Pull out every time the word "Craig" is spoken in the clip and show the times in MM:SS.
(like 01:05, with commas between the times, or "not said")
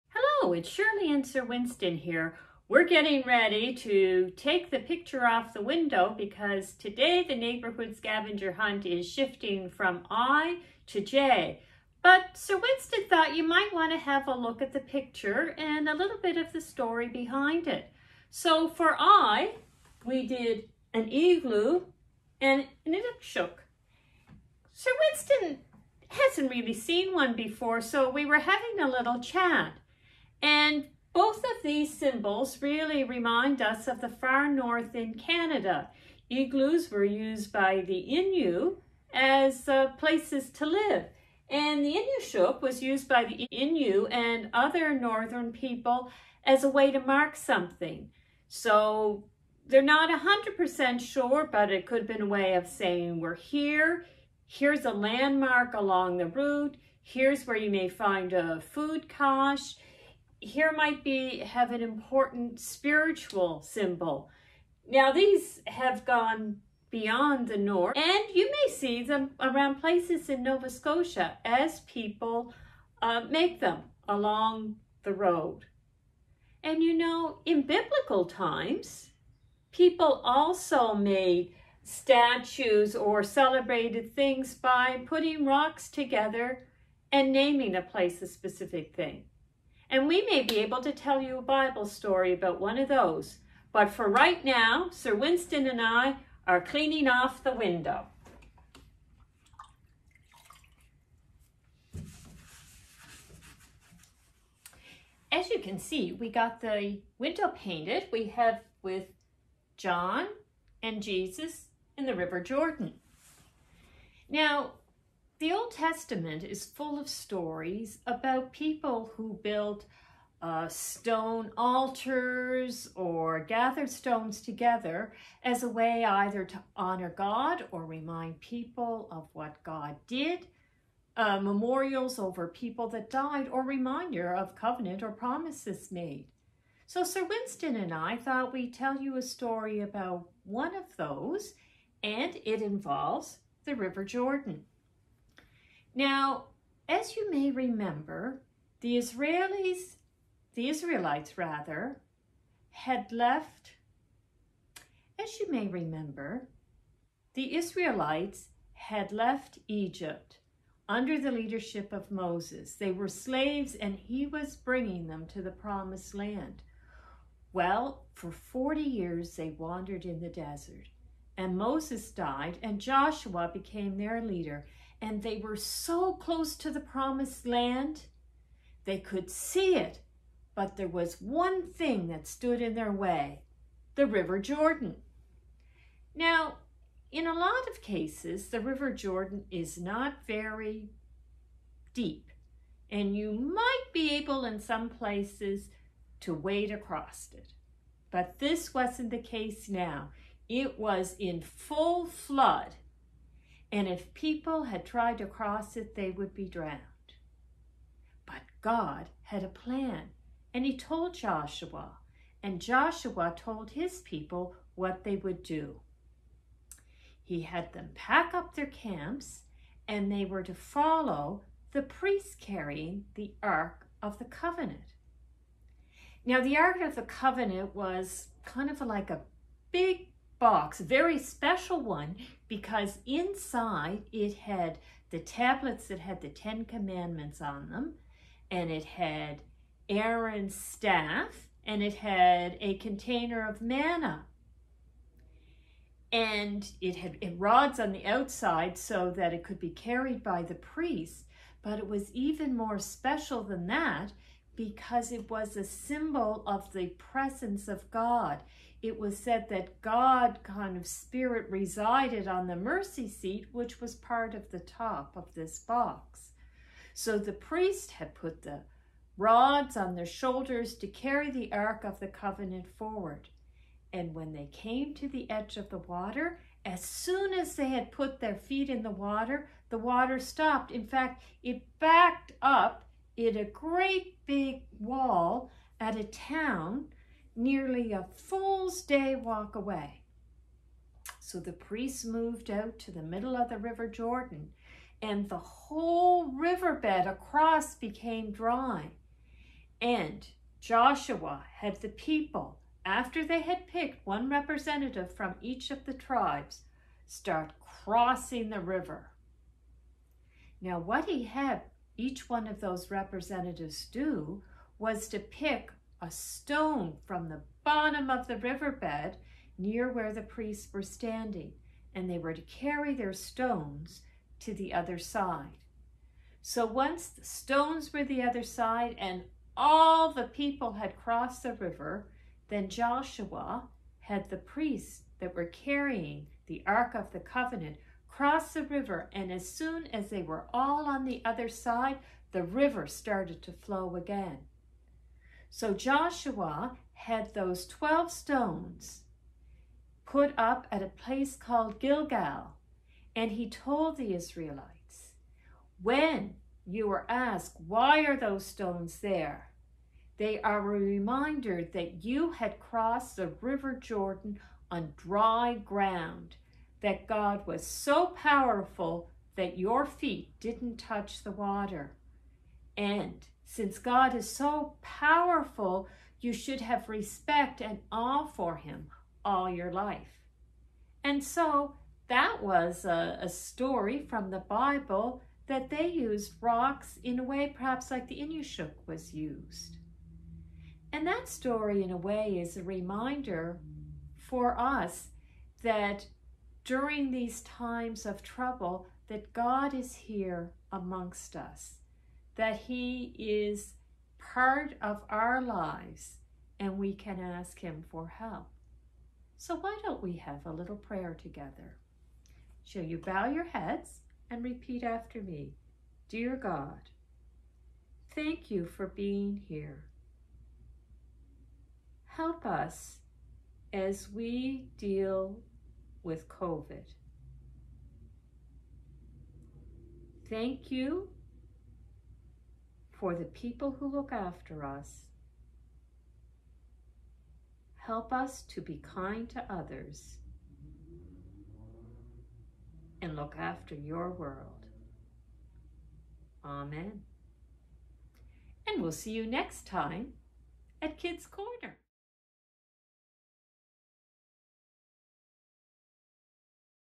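not said.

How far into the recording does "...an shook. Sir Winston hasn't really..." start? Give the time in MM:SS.
00:22.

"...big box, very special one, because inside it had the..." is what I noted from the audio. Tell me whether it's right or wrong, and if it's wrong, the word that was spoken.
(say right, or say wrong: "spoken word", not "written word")
right.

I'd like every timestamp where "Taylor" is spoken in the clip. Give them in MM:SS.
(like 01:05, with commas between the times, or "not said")
not said.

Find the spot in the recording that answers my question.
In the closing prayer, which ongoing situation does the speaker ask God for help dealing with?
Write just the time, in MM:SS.
07:06.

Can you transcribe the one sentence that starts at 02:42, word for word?
They were slaves and he was bringing them to the promised land.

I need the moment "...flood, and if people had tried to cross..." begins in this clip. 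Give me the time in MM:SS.
03:22.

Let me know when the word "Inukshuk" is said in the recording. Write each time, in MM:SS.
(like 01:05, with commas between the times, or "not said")
00:41, 06:28.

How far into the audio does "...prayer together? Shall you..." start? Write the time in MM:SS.
06:50.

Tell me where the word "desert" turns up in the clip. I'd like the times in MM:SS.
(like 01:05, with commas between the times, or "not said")
02:50.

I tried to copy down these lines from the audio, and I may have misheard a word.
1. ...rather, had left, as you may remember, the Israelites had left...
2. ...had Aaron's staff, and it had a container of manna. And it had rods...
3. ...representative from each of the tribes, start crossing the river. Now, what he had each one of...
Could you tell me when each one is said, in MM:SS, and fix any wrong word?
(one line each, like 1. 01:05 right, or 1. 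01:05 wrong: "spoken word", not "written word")
1. 02:31 right
2. 03:58 right
3. 05:04 right.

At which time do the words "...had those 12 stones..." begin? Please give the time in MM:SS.
05:46.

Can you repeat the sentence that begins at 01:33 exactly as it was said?
But for right now, Sir Winston and I are cleaning off the window.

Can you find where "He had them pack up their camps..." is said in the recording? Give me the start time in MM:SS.
03:37.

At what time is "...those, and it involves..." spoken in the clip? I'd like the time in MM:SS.
02:20.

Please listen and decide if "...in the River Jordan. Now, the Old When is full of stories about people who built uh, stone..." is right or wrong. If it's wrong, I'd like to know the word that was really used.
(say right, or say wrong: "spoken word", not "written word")
wrong: "Testament", not "When".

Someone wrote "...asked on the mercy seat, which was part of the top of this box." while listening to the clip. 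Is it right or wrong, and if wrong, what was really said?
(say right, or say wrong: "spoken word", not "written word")
wrong: "resided", not "asked".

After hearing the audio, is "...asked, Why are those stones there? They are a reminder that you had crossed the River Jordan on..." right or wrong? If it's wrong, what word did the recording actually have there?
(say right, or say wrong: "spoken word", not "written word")
right.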